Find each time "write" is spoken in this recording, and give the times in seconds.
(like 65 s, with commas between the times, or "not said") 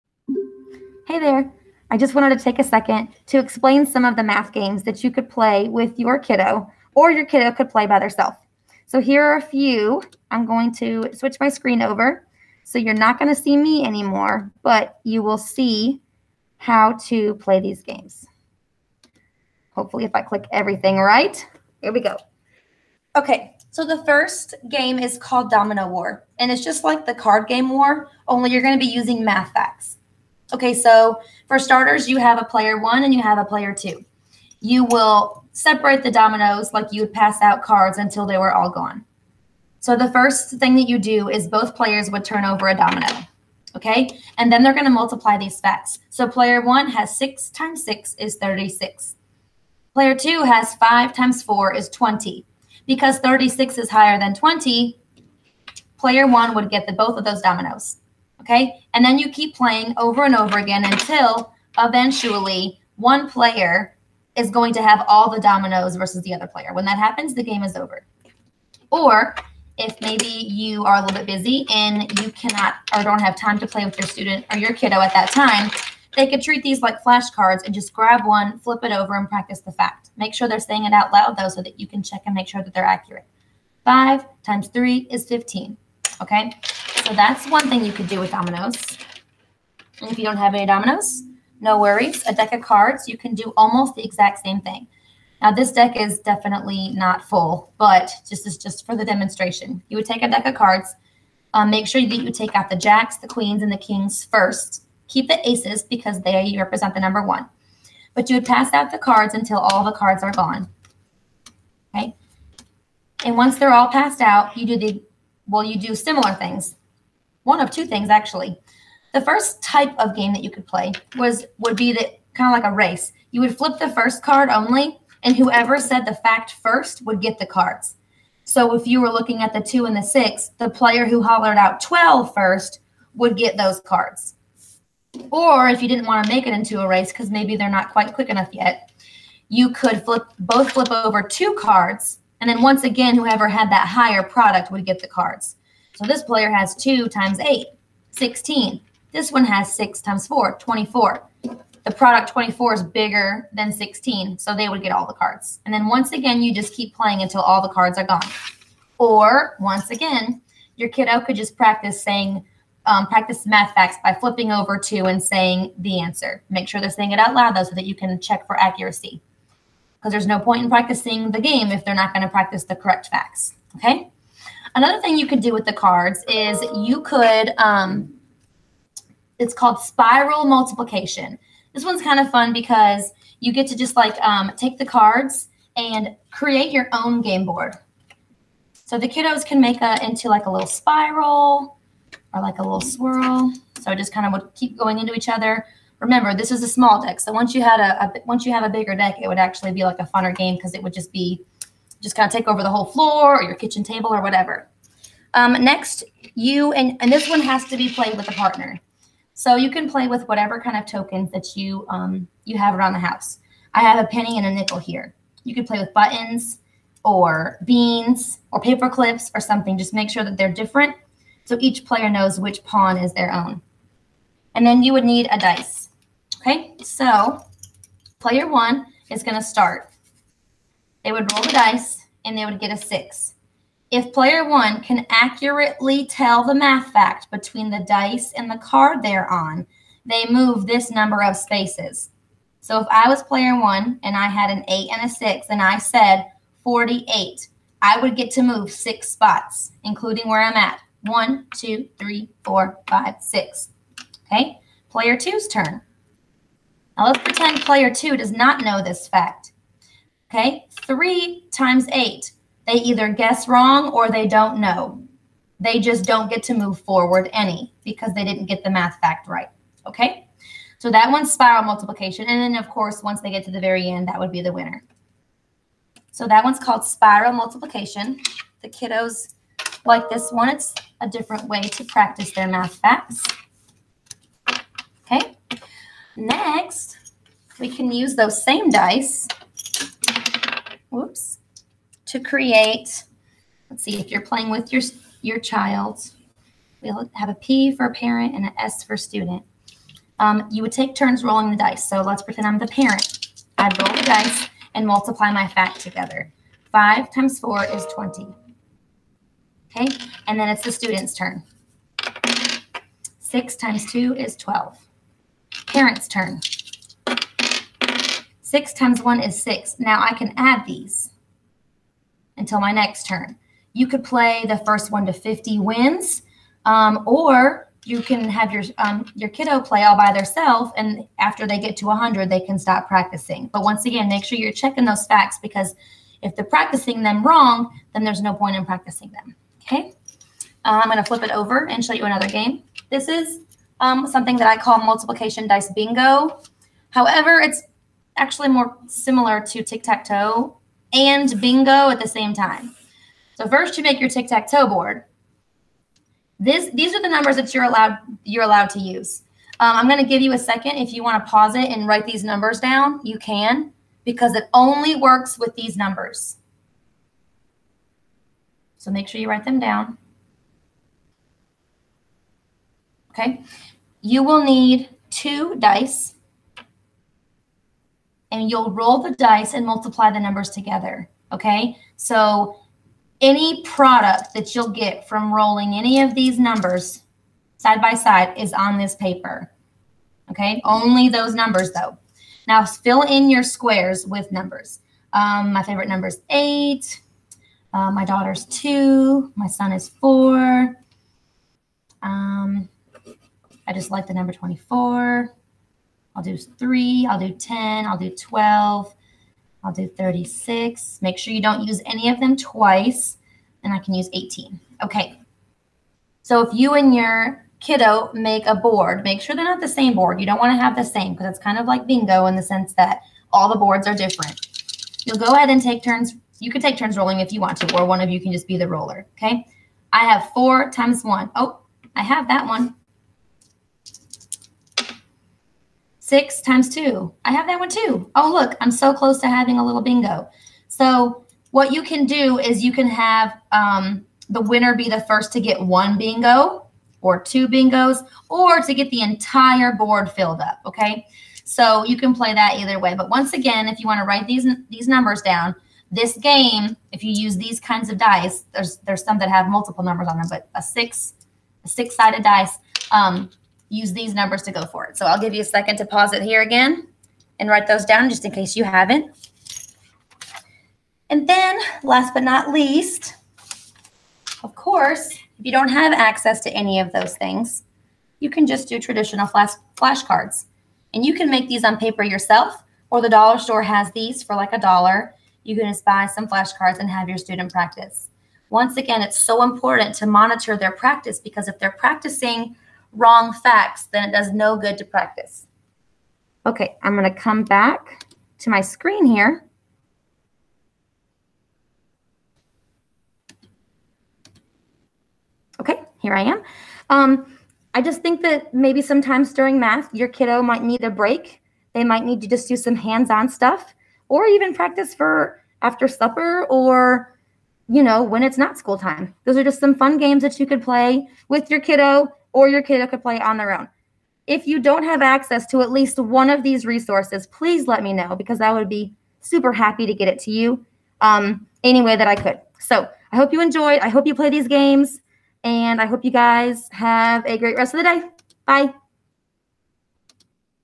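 361 s, 369 s, 454 s, 467 s.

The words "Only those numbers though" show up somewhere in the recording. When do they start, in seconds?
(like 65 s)
390 s.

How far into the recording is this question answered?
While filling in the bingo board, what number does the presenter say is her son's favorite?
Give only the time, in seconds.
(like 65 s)
399 s.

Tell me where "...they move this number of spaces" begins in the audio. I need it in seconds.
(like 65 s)
240 s.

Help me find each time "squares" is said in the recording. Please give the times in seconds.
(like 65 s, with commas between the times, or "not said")
393 s.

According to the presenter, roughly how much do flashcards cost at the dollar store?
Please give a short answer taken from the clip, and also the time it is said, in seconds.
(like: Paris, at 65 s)
A dollar, at 484 s.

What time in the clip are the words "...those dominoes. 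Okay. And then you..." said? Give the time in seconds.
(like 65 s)
57 s.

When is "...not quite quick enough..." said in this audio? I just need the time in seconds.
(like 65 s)
137 s.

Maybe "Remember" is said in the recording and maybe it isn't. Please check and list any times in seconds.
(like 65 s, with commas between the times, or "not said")
195 s.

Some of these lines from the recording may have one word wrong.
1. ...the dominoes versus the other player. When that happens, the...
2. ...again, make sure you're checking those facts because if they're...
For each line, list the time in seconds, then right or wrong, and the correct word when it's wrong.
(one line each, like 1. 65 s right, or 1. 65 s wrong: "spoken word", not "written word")
1. 65 s right
2. 333 s right.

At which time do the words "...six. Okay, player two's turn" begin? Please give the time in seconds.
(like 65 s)
253 s.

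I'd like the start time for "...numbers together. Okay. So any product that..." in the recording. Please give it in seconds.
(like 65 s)
380 s.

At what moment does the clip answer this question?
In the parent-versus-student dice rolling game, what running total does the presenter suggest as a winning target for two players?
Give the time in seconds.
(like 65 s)
324 s.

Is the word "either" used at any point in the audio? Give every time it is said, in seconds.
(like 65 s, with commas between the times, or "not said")
262 s, 452 s.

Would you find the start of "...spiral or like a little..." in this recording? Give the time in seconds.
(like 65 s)
190 s.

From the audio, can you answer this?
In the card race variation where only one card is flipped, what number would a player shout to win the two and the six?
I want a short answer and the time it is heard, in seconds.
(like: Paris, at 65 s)
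12, at 131 s.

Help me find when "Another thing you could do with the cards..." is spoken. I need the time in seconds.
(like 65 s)
174 s.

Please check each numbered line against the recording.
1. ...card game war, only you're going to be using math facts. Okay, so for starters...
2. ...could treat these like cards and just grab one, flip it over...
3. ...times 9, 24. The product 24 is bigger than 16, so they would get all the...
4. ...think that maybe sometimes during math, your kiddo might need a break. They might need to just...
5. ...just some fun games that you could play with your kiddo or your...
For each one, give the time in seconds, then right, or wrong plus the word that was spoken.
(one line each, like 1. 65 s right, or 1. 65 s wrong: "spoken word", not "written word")
1. 27 s right
2. 76 s wrong: "flashcards", not "cards"
3. 150 s wrong: "4", not "9"
4. 508 s right
5. 519 s right.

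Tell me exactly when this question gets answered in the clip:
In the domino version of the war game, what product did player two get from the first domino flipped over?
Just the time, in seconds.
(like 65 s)
50 s.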